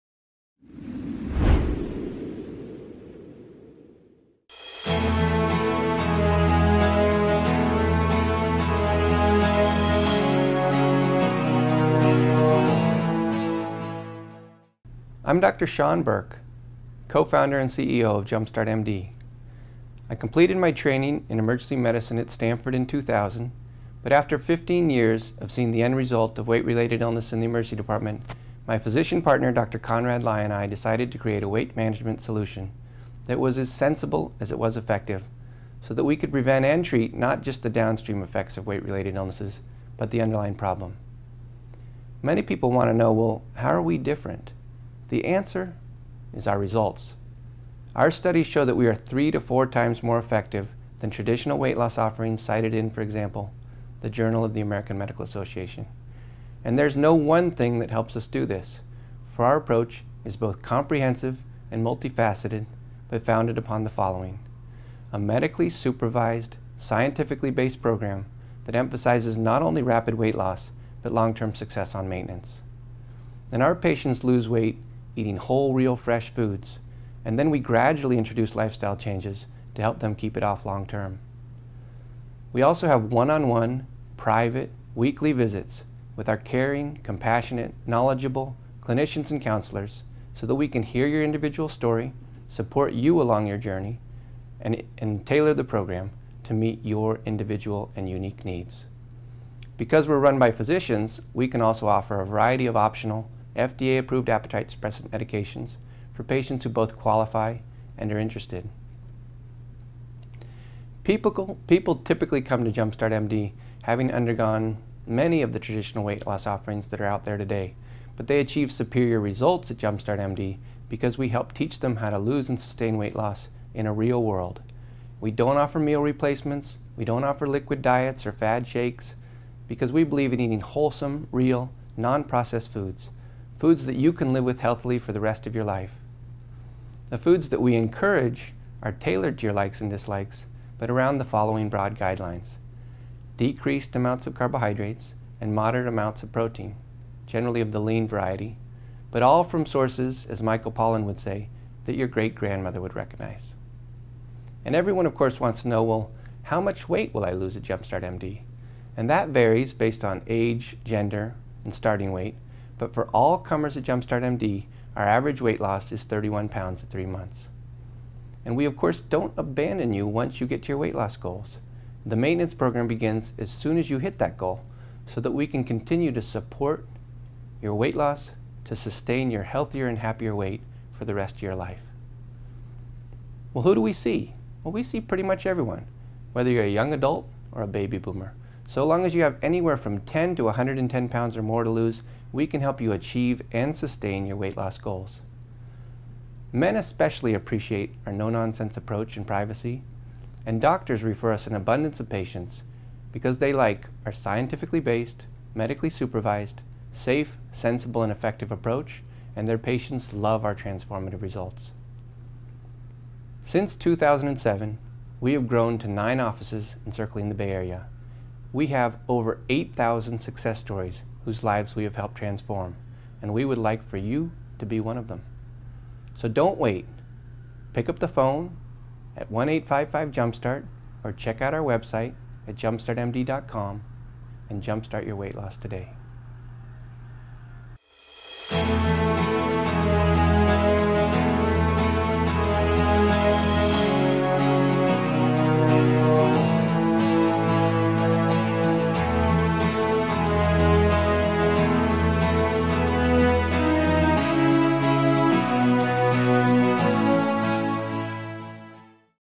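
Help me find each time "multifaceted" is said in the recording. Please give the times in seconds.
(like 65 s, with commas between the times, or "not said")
61 s.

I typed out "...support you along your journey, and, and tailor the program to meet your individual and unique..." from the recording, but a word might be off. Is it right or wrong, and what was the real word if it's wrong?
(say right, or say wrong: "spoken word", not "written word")
right.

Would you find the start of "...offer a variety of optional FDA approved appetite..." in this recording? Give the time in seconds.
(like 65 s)
101 s.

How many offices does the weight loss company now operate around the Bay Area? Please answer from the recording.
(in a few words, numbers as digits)
9.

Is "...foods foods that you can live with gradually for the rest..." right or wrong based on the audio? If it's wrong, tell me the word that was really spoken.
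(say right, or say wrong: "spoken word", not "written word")
wrong: "healthily", not "gradually".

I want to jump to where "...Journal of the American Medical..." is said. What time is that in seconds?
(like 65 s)
54 s.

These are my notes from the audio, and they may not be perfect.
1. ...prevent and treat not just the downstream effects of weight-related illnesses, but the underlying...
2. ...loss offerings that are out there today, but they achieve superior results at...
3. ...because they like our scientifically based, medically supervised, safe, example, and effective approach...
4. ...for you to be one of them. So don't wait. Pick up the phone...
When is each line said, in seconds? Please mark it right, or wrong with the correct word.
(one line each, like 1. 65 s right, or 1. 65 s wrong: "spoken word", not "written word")
1. 36 s right
2. 116 s right
3. 203 s wrong: "sensible", not "example"
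4. 223 s right.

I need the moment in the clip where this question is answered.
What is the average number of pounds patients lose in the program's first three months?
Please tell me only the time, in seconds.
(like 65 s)
166 s.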